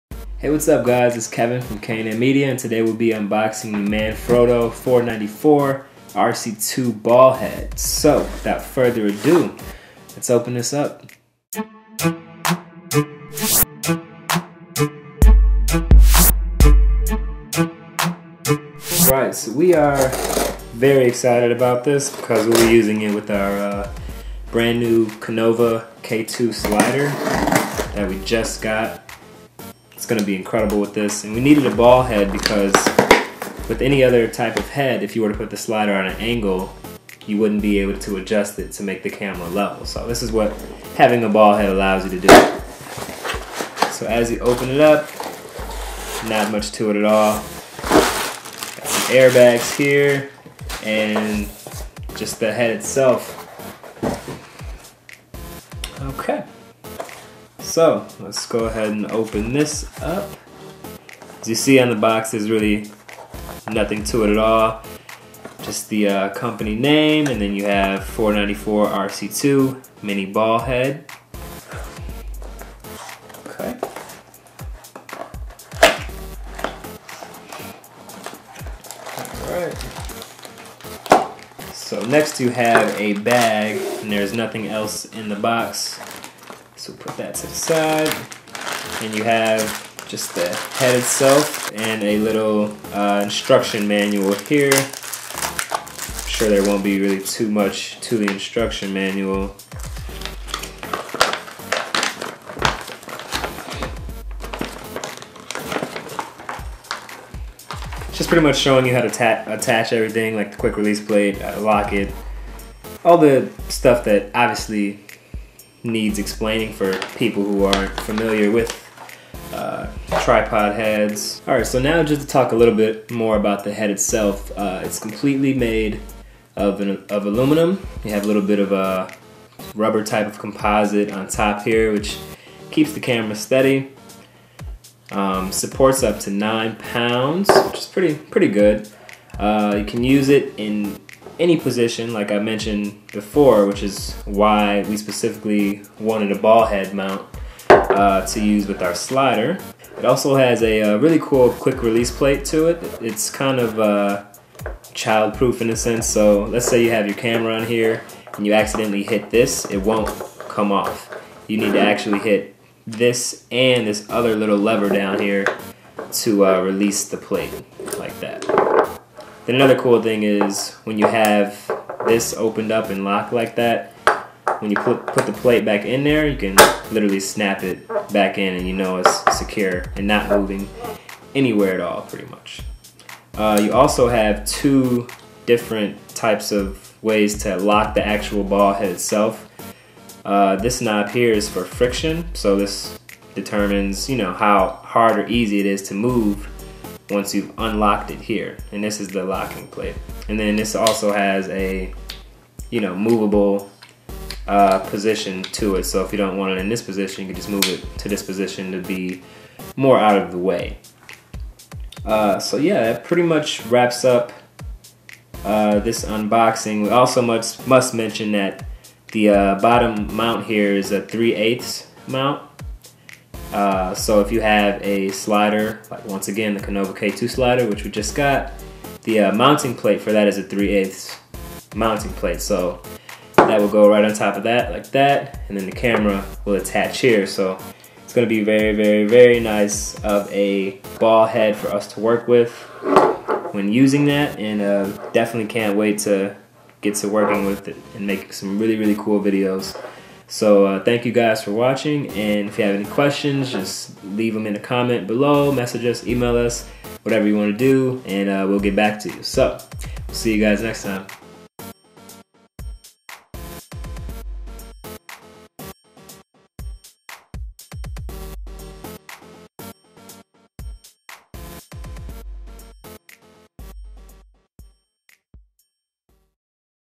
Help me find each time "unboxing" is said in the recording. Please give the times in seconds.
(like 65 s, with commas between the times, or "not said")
3 s, 216 s.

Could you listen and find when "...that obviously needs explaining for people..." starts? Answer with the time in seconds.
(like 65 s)
114 s.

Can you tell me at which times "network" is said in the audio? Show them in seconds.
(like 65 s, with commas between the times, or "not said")
not said.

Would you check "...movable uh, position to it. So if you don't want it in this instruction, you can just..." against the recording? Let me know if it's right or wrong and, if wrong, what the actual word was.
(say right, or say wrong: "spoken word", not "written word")
wrong: "position", not "instruction".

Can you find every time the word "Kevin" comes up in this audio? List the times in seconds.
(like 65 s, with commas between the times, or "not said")
1 s.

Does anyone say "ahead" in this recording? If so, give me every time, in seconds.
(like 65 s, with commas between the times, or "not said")
58 s.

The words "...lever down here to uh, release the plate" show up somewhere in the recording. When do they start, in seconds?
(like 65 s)
164 s.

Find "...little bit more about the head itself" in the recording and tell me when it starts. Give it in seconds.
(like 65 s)
122 s.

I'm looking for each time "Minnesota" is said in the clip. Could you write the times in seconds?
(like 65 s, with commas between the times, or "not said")
not said.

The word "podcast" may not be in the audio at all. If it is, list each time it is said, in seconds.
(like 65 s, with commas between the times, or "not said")
not said.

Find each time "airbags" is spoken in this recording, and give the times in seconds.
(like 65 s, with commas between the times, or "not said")
49 s.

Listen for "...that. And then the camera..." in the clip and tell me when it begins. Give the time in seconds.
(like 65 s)
234 s.